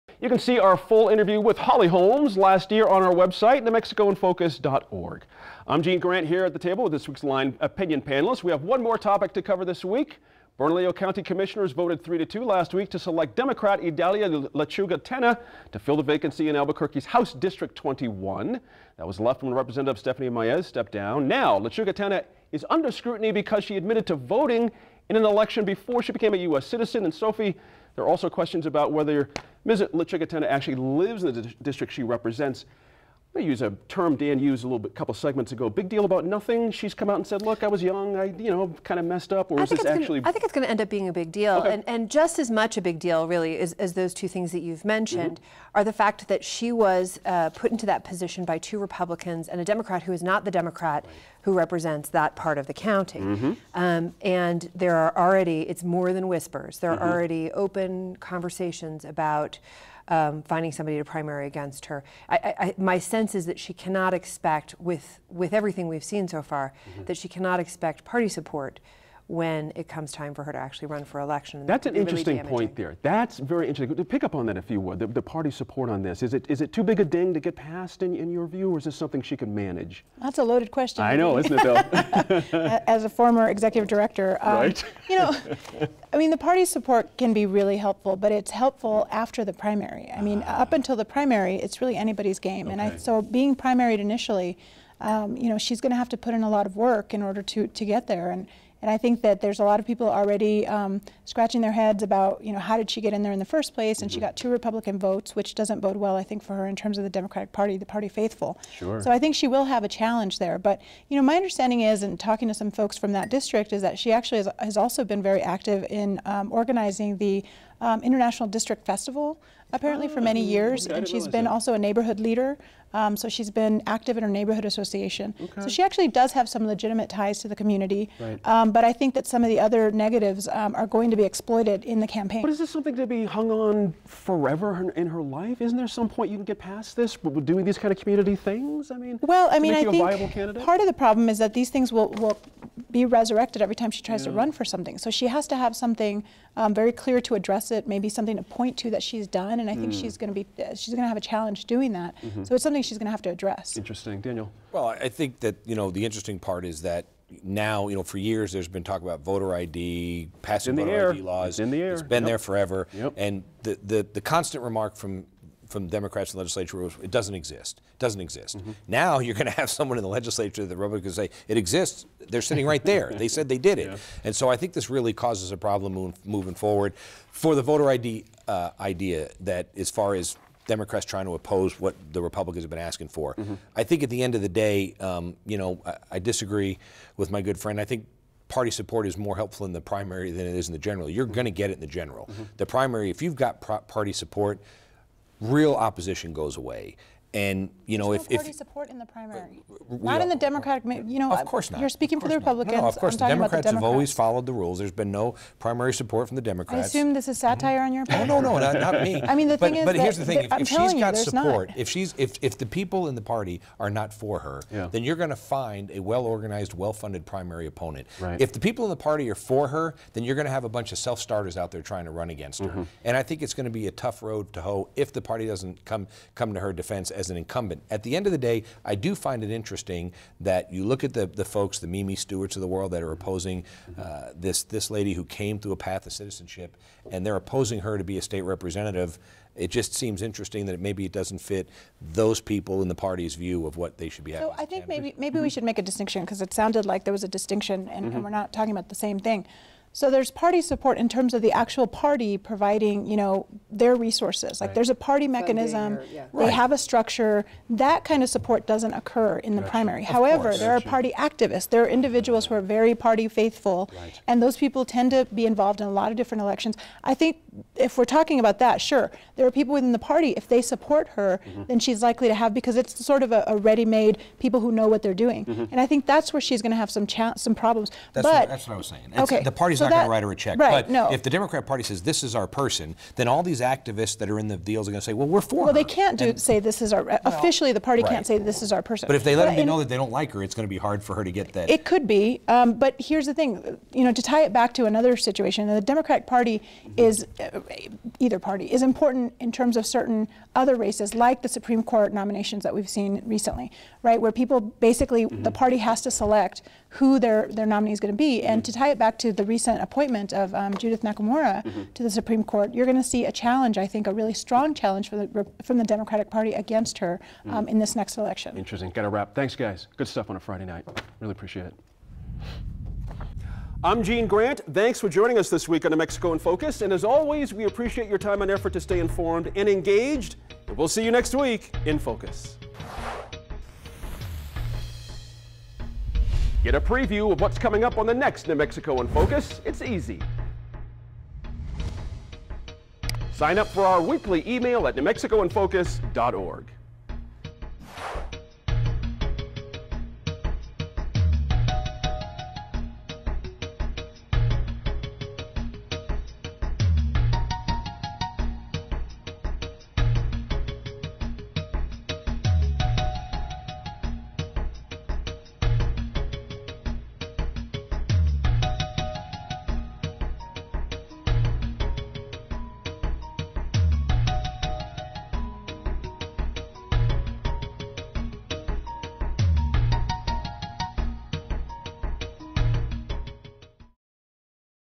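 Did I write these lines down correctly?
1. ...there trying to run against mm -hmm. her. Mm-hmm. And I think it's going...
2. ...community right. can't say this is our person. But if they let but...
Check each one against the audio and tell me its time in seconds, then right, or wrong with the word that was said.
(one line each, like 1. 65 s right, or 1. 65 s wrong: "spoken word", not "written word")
1. 221 s right
2. 287 s wrong: "party", not "community".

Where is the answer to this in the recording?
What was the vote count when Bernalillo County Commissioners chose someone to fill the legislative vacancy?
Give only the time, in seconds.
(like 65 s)
12 s.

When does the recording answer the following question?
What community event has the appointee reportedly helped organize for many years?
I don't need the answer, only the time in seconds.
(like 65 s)
118 s.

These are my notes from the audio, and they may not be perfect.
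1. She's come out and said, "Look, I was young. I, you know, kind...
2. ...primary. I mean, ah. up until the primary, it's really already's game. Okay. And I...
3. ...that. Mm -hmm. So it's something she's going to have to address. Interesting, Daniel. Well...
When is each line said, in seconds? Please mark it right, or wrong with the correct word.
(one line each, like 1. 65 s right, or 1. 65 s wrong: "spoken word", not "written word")
1. 36 s right
2. 89 s wrong: "anybody", not "already"
3. 151 s right.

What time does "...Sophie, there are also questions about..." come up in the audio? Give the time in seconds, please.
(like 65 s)
27 s.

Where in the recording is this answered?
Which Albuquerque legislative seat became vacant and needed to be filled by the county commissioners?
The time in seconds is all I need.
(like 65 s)
17 s.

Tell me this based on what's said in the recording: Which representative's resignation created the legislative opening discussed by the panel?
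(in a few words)
Stephanie Maez.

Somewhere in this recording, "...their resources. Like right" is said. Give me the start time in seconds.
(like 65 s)
253 s.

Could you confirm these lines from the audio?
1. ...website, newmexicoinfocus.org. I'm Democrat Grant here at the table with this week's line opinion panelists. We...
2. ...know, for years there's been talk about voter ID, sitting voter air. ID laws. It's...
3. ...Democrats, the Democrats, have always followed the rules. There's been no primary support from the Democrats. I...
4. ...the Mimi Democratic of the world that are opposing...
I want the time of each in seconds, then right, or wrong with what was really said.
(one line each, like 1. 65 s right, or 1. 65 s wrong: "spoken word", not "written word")
1. 3 s wrong: "Gene", not "Democrat"
2. 157 s wrong: "passing", not "sitting"
3. 203 s right
4. 231 s wrong: "Stewarts", not "Democratic".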